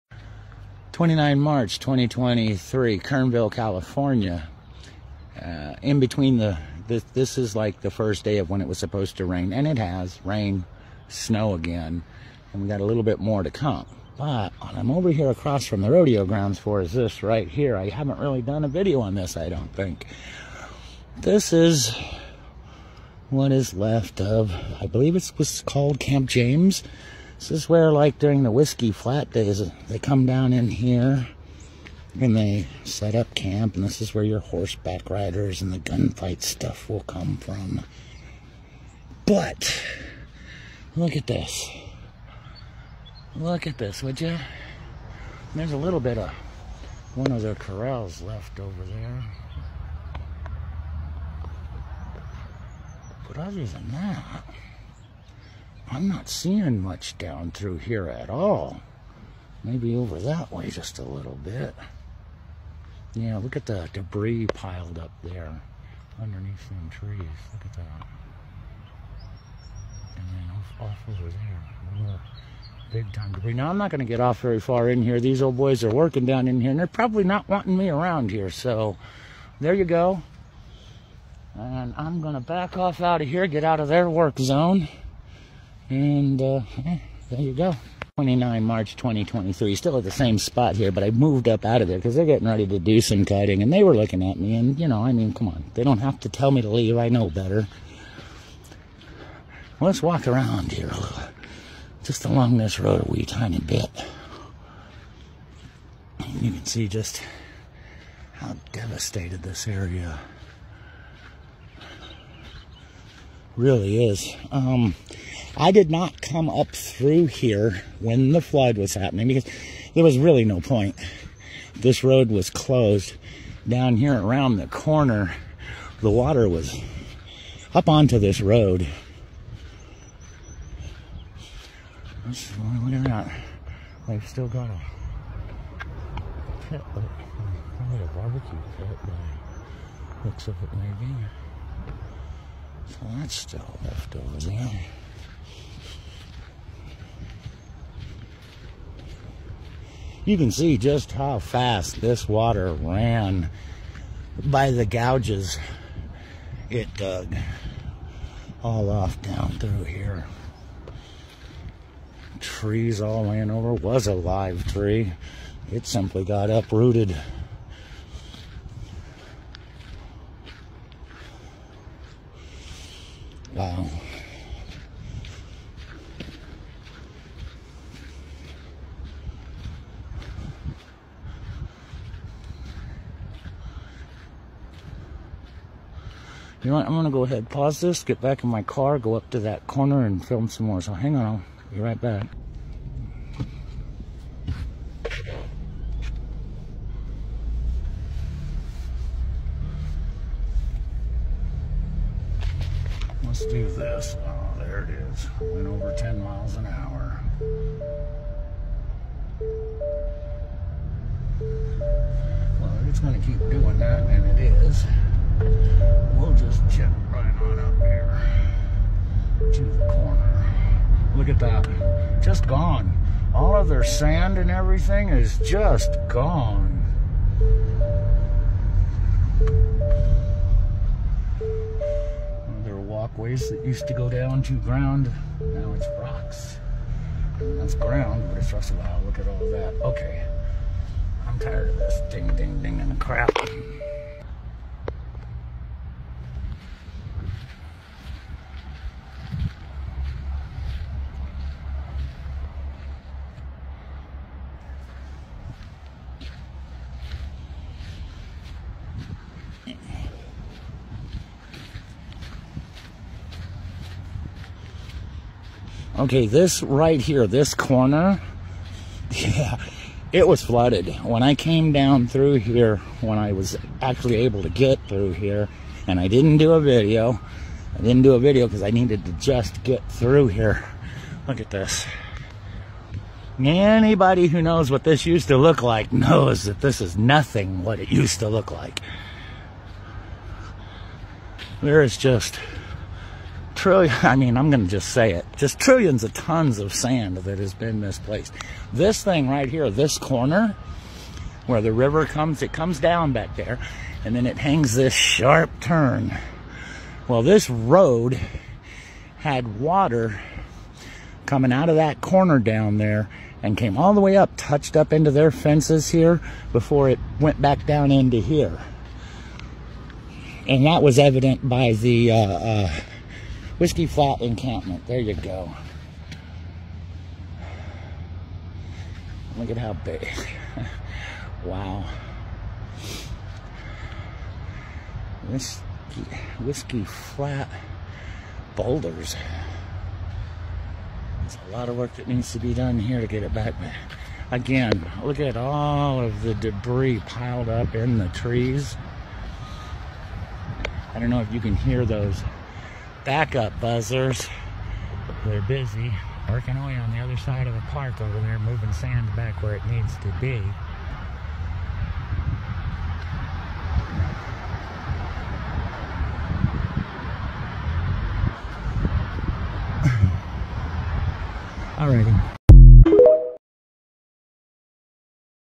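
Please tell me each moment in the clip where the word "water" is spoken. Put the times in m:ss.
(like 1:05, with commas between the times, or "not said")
2:06, 2:32, 5:09.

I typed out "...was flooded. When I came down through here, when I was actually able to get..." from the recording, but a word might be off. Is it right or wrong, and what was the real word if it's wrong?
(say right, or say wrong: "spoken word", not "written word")
right.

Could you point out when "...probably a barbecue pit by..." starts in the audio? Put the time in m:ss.
2:16.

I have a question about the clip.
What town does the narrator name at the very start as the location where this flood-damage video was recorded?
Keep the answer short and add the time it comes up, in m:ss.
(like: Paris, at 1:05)
Kernville, California, at 0:02.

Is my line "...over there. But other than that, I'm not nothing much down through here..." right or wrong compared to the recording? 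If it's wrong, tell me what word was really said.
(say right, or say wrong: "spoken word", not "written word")
wrong: "seeing", not "nothing".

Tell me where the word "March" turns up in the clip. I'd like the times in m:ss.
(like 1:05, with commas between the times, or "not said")
0:01, 1:28.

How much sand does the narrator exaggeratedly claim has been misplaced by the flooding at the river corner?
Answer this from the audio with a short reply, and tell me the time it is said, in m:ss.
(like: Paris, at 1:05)
trillions of tons, at 4:55.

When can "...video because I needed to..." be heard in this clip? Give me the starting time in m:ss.
4:38.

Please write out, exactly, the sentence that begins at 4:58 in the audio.
This thing right here, this corner, where the river comes, it comes down back there, and then it hangs this sharp turn.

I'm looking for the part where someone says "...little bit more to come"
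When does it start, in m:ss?
0:12.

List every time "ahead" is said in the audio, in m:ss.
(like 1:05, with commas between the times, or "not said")
3:07.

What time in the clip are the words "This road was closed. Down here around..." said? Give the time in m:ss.
2:01.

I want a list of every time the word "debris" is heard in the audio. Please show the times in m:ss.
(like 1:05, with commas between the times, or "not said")
1:03, 1:13, 5:46.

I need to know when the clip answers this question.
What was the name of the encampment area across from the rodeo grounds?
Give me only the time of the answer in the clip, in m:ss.
0:25.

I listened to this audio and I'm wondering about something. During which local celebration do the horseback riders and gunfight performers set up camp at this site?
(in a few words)
Whiskey Flat Days.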